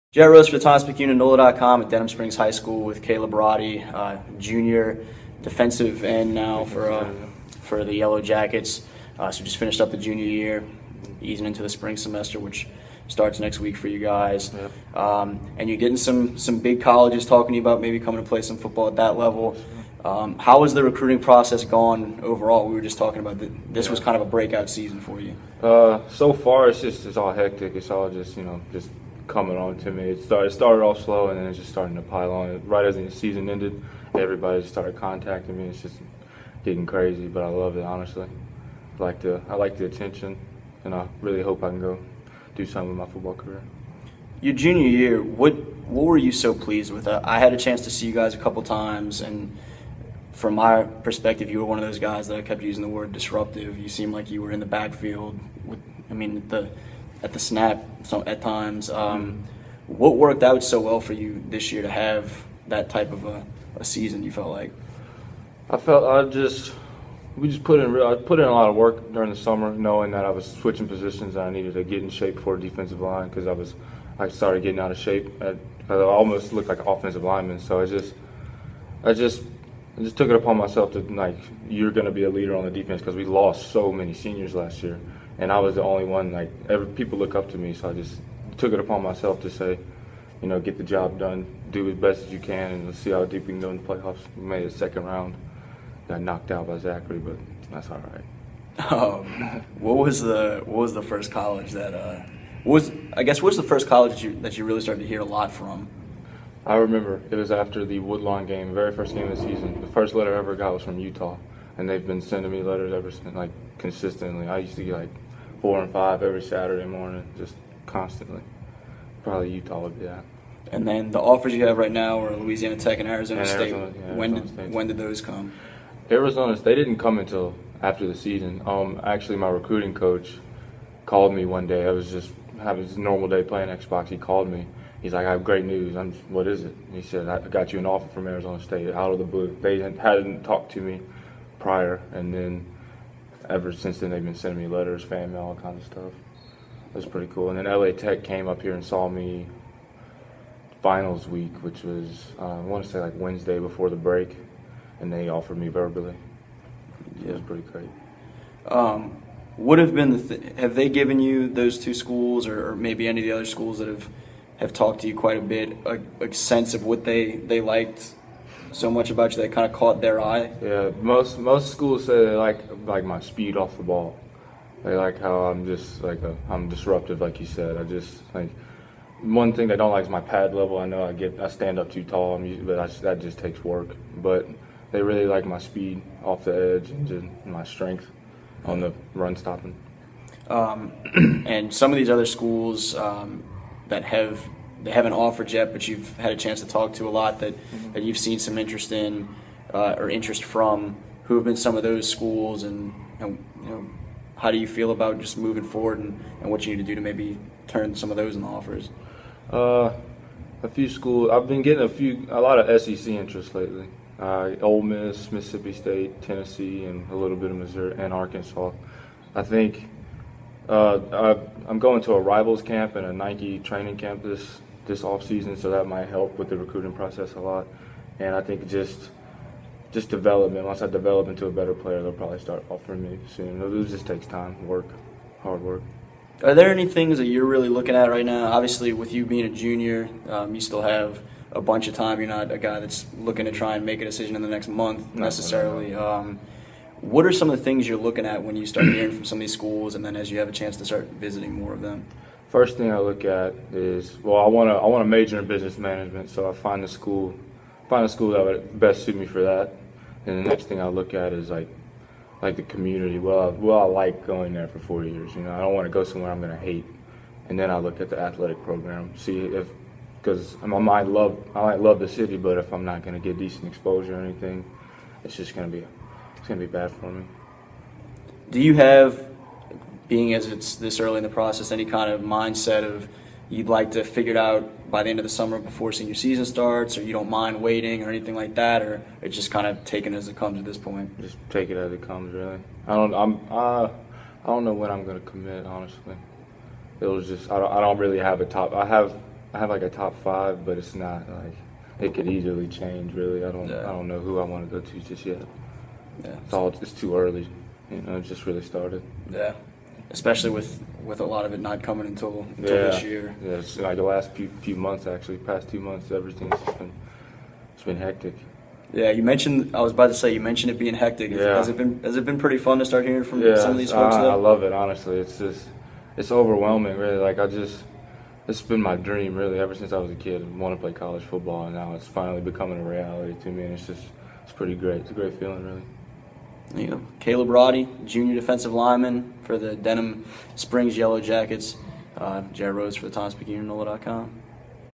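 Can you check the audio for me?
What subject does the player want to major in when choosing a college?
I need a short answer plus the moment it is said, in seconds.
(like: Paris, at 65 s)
Business management, at 255 s.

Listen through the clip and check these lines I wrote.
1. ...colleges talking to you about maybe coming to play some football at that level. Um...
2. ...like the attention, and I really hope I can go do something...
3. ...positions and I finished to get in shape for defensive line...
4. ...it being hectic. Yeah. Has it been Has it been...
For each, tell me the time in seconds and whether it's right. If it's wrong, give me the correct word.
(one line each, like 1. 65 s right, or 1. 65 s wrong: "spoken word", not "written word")
1. 16 s right
2. 39 s right
3. 70 s wrong: "needed", not "finished"
4. 320 s right.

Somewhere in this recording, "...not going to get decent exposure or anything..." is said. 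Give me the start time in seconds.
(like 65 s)
272 s.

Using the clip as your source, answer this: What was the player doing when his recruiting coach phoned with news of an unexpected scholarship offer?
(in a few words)
Playing Xbox.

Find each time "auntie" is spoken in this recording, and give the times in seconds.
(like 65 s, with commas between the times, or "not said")
not said.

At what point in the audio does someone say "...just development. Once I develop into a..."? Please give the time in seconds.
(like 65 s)
229 s.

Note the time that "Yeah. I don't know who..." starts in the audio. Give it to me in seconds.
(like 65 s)
303 s.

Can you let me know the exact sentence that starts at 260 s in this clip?
And the next thing I look at is like like the community.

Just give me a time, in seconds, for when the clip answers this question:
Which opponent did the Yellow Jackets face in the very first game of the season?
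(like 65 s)
107 s.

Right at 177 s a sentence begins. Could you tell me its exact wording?
I just like one thing they don't like is my pad level.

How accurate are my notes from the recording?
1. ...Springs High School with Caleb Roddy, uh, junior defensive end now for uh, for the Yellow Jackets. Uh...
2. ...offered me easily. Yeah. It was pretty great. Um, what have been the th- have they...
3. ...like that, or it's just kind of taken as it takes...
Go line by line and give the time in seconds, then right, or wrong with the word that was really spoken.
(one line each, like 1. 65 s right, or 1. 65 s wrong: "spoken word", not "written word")
1. 2 s right
2. 155 s wrong: "verbally", not "easily"
3. 288 s wrong: "comes", not "takes".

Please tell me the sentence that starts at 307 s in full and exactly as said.
You know, it just really started.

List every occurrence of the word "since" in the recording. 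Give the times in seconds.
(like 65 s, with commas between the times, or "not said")
113 s, 143 s, 329 s.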